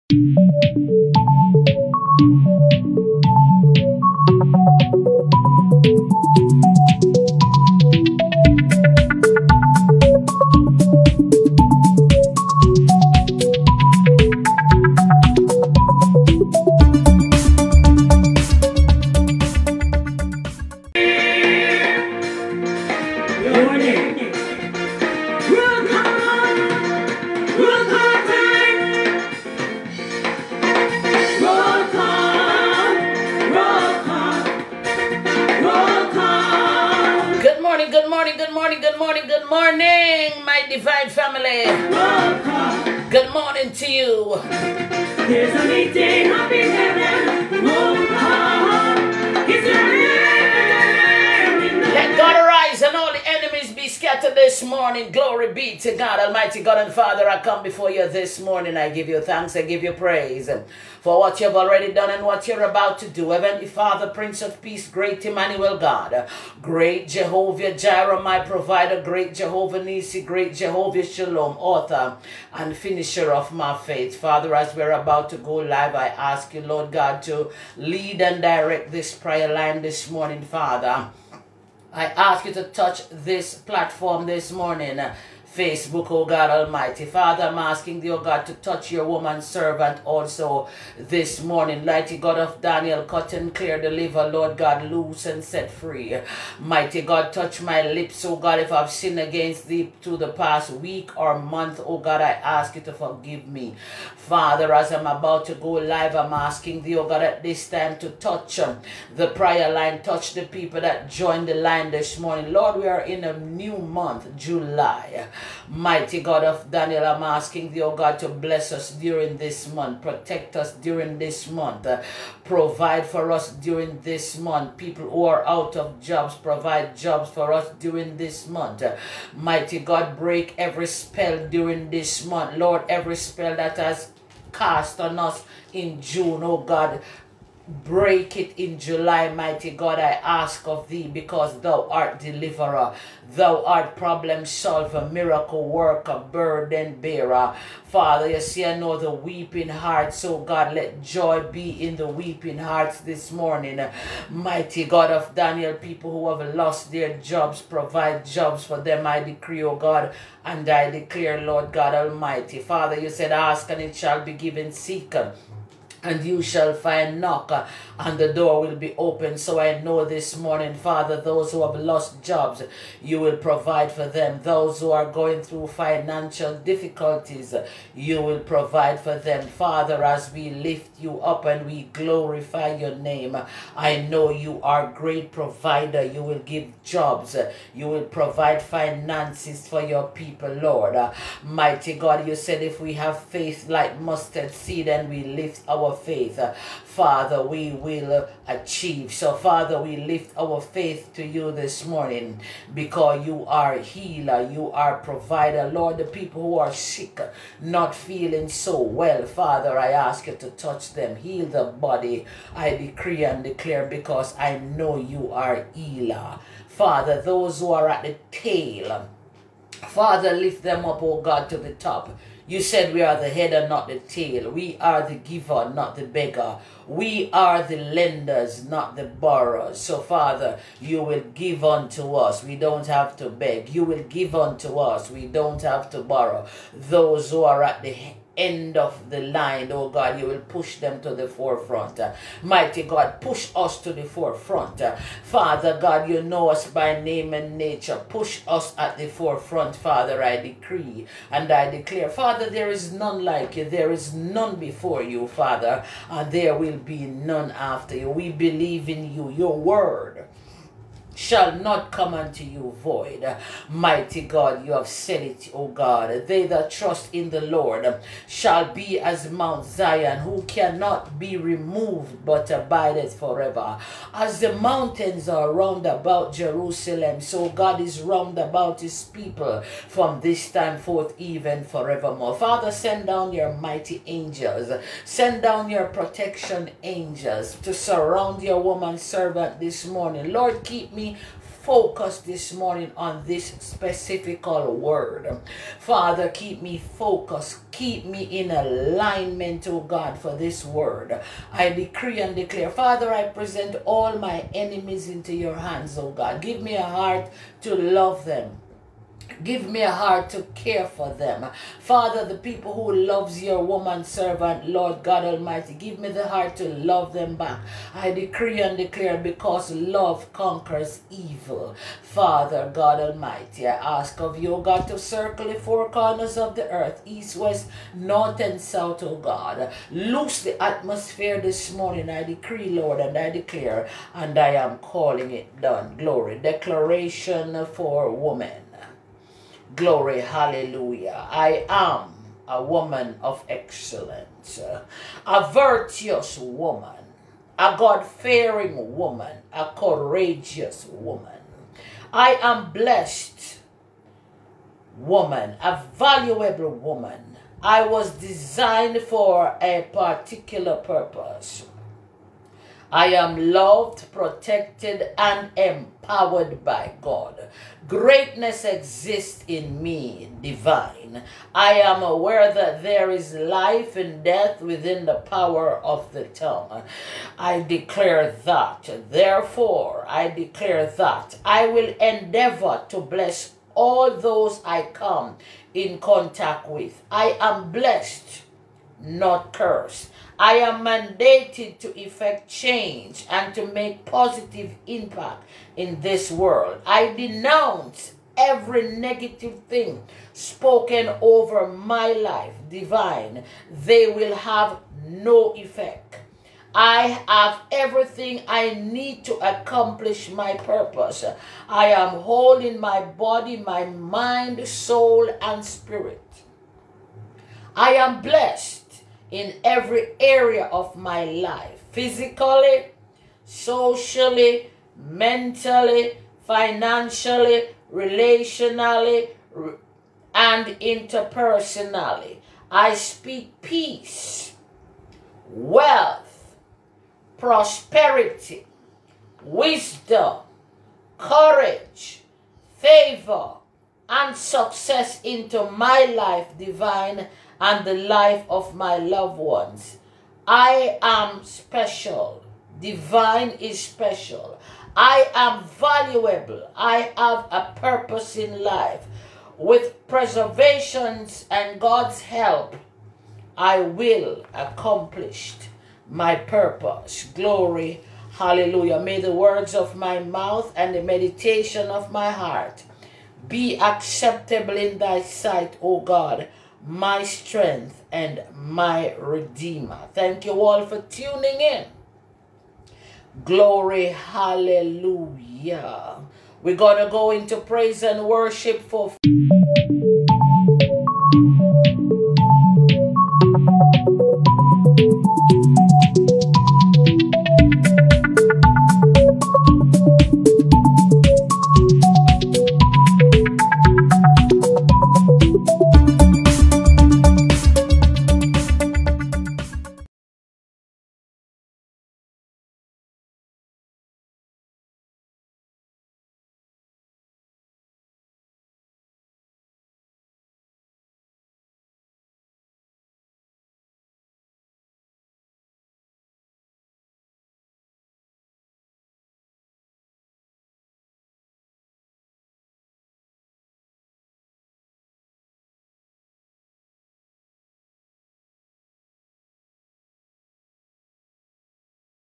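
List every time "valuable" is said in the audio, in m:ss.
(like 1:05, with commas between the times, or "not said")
5:55, 7:35.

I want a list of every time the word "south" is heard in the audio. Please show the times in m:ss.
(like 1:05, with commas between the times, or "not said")
5:28.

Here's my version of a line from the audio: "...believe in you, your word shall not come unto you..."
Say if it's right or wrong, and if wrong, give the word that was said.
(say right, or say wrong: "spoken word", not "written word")
right.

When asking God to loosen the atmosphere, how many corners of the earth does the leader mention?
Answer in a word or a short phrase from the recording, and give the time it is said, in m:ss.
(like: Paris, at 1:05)
4, at 5:25.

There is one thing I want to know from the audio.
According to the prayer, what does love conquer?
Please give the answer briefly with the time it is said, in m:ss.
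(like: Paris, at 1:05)
Evil, at 5:21.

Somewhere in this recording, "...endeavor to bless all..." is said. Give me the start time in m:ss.
6:21.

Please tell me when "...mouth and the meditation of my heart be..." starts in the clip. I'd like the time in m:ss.
7:50.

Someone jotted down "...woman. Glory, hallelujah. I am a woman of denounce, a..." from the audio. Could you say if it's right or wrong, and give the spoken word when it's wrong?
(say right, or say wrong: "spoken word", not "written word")
wrong: "excellence", not "denounce".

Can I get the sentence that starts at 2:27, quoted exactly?
Father, you see, I know the weeping hearts.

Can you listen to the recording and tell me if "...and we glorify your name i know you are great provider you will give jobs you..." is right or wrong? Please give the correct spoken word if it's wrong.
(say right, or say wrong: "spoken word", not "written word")
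right.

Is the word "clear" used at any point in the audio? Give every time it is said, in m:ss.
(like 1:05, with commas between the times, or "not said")
1:33.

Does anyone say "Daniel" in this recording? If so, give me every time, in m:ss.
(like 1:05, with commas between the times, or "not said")
1:32, 1:56, 2:35.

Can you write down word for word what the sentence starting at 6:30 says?
I am mandated to effect change and to make positive impact in this world.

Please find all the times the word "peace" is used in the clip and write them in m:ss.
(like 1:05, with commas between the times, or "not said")
1:04, 7:13.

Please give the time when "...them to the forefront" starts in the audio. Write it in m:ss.
4:00.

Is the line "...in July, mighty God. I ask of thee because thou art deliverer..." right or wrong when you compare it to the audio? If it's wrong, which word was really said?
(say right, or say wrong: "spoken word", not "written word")
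right.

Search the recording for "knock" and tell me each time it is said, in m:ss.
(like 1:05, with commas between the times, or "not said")
2:47.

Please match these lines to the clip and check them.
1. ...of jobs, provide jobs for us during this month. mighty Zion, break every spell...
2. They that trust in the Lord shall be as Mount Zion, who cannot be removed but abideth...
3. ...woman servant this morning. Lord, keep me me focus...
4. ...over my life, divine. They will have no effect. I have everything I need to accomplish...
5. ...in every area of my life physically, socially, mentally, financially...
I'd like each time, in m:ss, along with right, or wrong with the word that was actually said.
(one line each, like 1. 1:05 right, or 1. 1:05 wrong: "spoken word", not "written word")
1. 2:05 wrong: "God", not "Zion"
2. 4:26 right
3. 4:48 right
4. 6:41 right
5. 6:59 right.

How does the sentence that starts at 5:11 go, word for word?
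Father, the people who loves your woman servant, Lord God Almighty, give me the heart to love them back.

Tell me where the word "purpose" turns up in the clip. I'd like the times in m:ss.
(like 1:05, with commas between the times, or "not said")
6:00, 6:50, 7:37, 7:46.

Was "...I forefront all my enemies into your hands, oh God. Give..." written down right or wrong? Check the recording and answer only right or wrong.
wrong.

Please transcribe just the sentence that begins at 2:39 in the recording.
I decree, O oh God, and I declare, Lord God Almighty.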